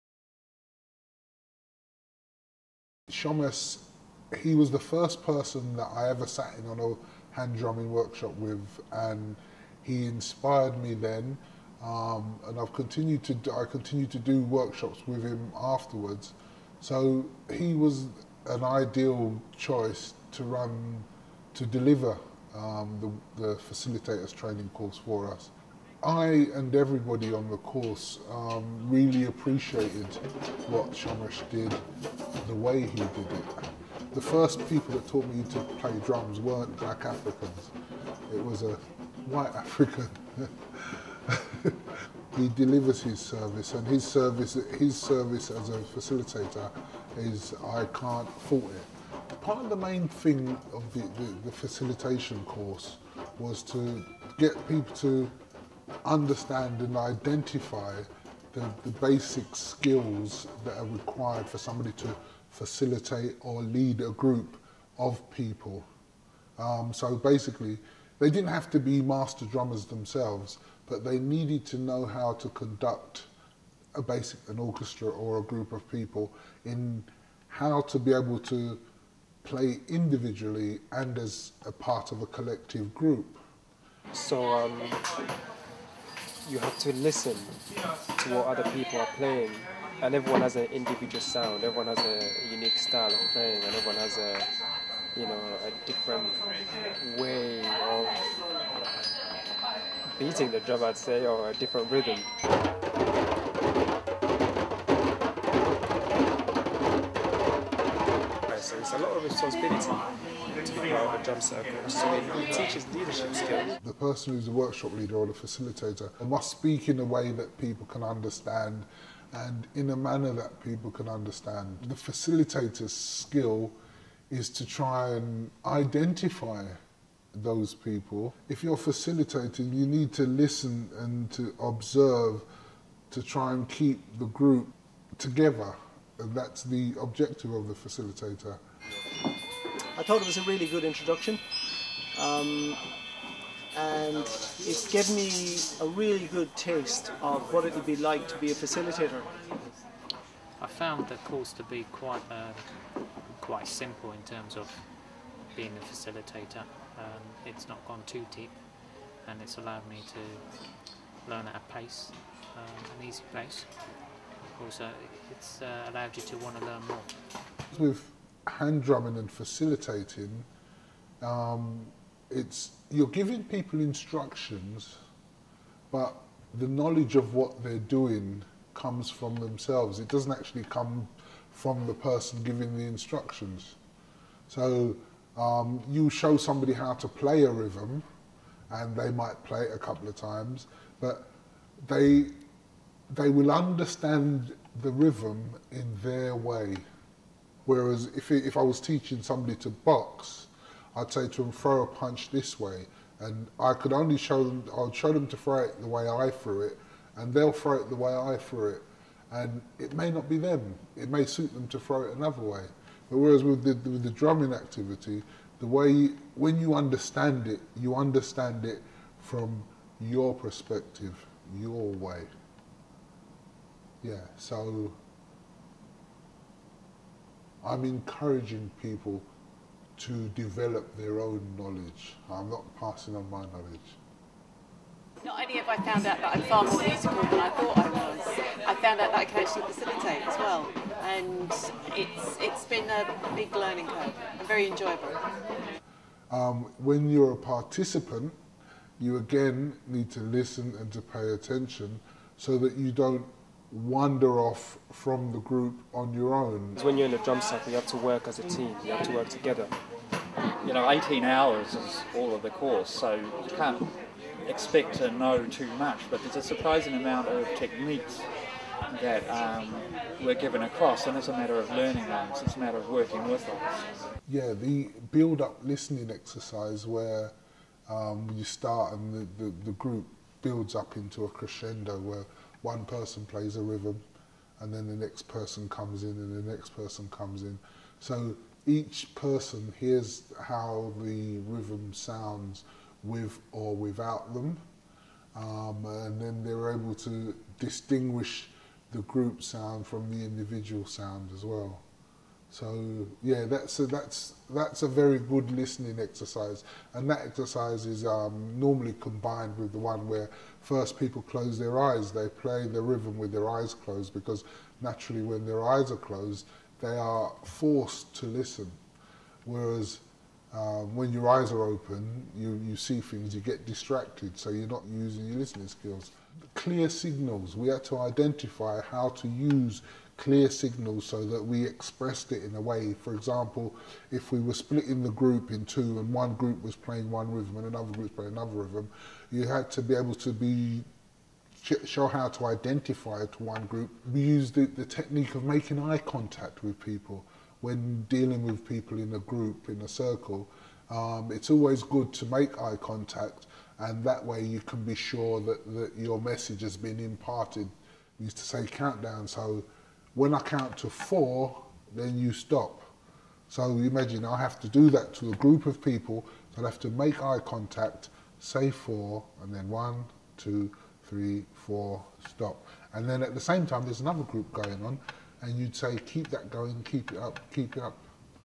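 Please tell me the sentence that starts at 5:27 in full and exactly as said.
We have to identify how to use clear signals so that we expressed it in a way.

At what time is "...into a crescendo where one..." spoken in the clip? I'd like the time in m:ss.
4:40.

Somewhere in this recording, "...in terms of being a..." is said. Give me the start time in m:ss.
2:34.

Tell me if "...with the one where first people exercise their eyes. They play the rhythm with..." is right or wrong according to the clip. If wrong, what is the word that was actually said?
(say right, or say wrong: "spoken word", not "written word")
wrong: "close", not "exercise".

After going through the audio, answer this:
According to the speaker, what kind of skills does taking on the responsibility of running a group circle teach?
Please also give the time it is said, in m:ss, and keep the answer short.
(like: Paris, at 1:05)
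leadership skills, at 1:52.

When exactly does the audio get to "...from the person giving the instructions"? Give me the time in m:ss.
3:01.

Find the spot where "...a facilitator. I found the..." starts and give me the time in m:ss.
2:28.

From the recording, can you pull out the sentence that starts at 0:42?
he delivers his service, and his service, his service as a facilitator, is I can't fault it.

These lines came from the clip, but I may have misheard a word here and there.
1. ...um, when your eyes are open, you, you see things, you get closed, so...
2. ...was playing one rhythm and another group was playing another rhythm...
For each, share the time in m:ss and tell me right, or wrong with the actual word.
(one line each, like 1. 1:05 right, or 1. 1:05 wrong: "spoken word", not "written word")
1. 5:20 wrong: "distracted", not "closed"
2. 5:36 right.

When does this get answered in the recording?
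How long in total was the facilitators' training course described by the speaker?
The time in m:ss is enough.
4:20.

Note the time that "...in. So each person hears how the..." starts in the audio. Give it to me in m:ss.
4:47.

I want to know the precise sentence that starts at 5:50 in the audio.
Um, it's always good to make eye contact and that way you can be sure that, that your message has been imparted.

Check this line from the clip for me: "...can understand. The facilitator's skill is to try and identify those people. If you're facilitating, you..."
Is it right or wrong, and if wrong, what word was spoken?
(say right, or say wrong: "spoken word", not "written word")
right.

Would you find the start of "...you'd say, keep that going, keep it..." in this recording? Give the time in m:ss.
6:15.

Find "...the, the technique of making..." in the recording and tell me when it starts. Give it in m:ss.
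5:44.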